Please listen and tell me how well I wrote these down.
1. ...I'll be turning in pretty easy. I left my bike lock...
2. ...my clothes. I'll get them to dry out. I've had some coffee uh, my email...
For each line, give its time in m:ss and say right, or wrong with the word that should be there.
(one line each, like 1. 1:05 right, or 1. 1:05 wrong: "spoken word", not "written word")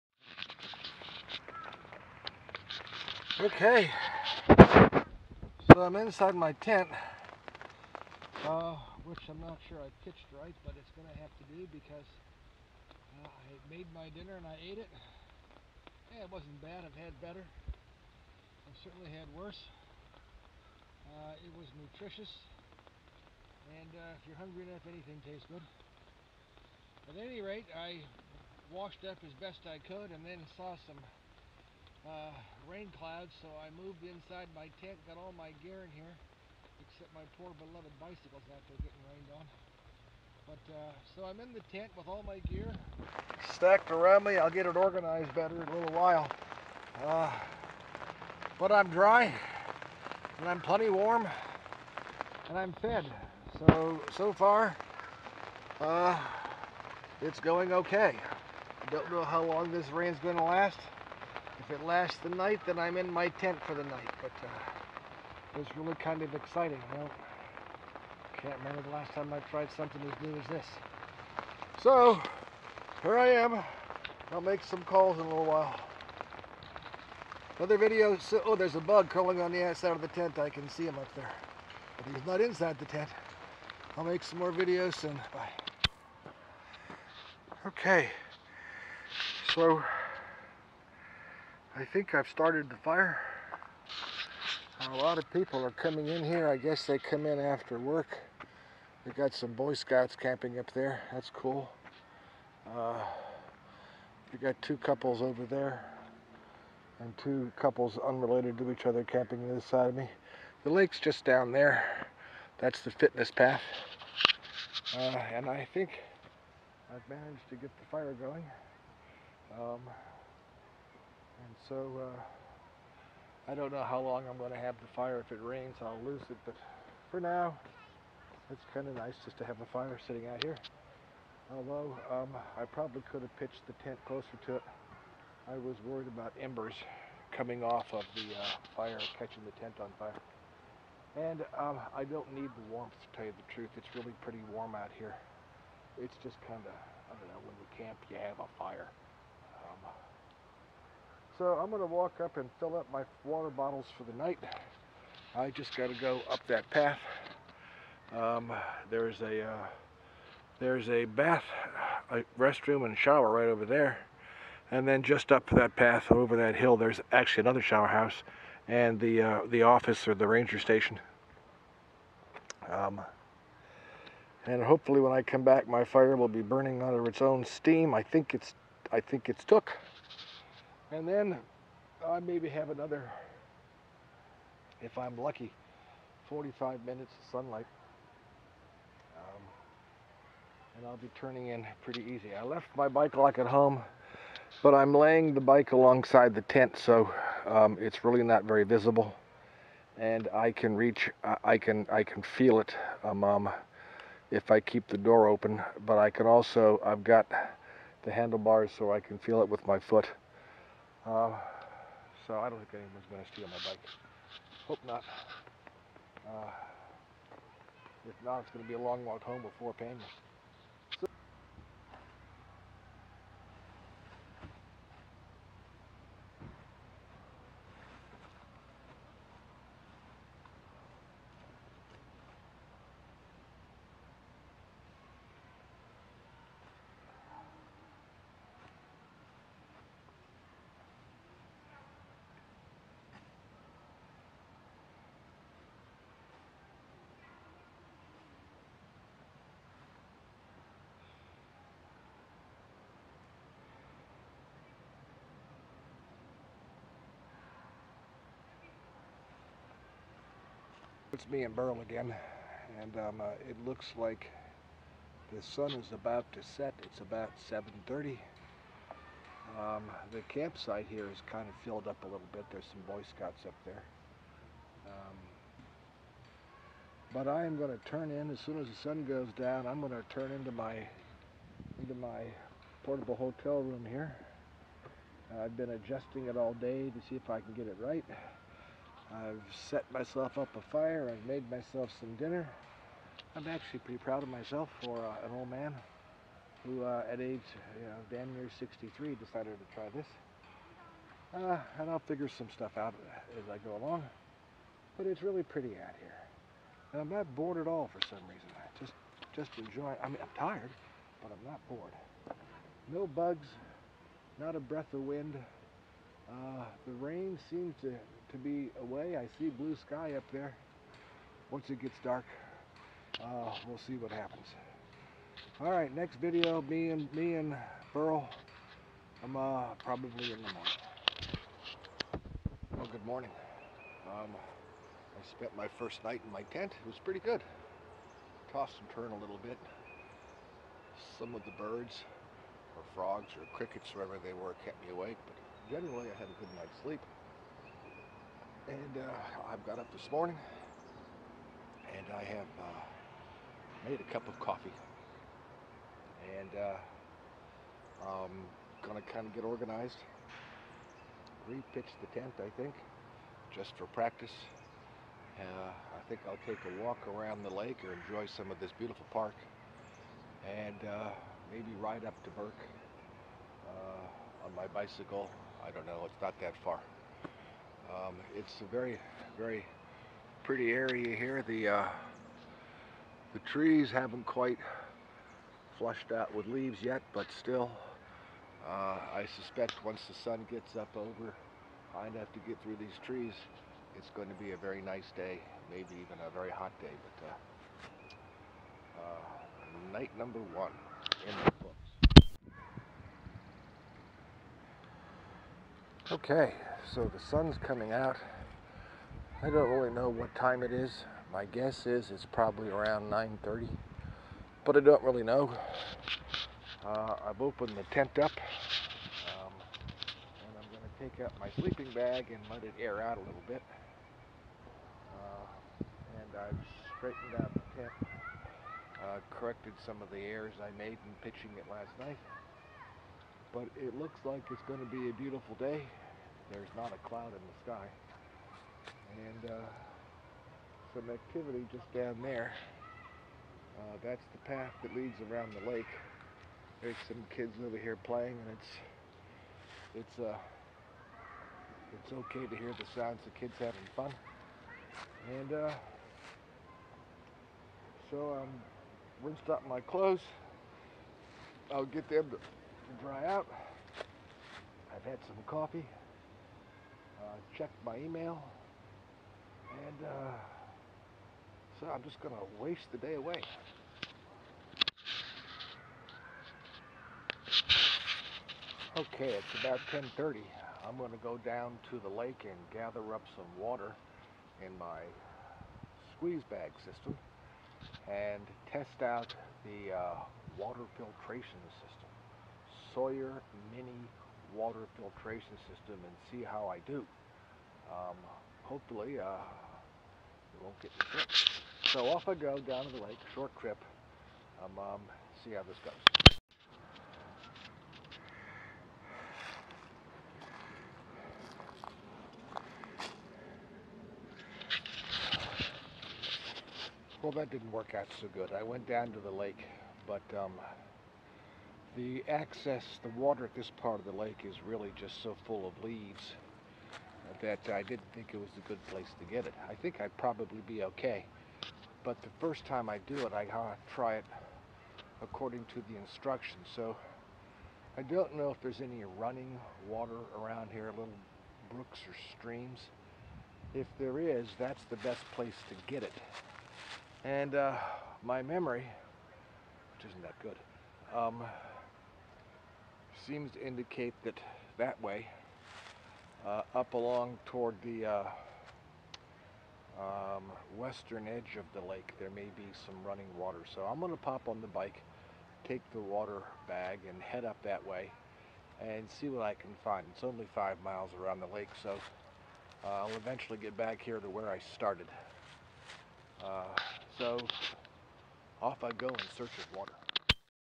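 1. 3:10 right
2. 7:39 right.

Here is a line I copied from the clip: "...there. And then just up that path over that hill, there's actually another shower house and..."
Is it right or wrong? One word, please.
right.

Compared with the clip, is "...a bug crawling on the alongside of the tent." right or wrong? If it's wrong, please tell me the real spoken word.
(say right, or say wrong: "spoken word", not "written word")
wrong: "outside", not "alongside".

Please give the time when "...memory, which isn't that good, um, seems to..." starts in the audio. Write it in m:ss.
9:08.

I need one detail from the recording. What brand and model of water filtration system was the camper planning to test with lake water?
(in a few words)
Sawyer Mini.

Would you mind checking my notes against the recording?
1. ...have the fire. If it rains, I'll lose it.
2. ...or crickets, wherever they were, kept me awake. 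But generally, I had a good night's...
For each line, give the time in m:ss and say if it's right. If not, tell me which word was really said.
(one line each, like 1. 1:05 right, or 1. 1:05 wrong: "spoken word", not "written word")
1. 2:04 right
2. 5:43 right.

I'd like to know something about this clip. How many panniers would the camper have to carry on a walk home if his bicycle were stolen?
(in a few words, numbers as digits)
4.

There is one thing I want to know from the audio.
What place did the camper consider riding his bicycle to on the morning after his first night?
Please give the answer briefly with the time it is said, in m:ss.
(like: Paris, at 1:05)
Burke, at 6:12.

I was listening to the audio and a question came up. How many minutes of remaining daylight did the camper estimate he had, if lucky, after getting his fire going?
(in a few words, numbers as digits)
45.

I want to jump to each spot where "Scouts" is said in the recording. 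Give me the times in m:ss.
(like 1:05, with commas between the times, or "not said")
1:39, 4:33.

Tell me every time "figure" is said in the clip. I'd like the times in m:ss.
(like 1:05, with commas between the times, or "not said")
5:02.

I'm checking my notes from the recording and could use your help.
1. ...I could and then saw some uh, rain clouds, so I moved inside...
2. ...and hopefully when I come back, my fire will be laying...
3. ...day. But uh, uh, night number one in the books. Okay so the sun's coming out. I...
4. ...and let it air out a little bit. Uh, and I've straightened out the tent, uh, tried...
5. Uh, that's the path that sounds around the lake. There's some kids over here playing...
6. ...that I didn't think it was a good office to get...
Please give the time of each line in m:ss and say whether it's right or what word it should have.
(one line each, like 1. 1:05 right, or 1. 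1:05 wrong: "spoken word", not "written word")
1. 0:29 right
2. 2:54 wrong: "burning", not "laying"
3. 6:36 right
4. 7:02 wrong: "corrected", not "tried"
5. 7:23 wrong: "leads", not "sounds"
6. 8:47 wrong: "place", not "office".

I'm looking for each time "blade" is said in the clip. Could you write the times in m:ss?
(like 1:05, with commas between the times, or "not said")
not said.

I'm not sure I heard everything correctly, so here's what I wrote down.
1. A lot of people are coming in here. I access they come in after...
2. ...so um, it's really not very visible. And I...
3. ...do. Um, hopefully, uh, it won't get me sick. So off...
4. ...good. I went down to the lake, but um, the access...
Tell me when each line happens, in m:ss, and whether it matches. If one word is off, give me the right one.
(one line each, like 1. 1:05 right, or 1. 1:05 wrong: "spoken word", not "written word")
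1. 1:34 wrong: "guess", not "access"
2. 3:16 right
3. 8:16 right
4. 8:38 right.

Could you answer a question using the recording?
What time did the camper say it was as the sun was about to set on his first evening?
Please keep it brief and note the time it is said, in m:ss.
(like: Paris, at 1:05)
7:30, at 4:27.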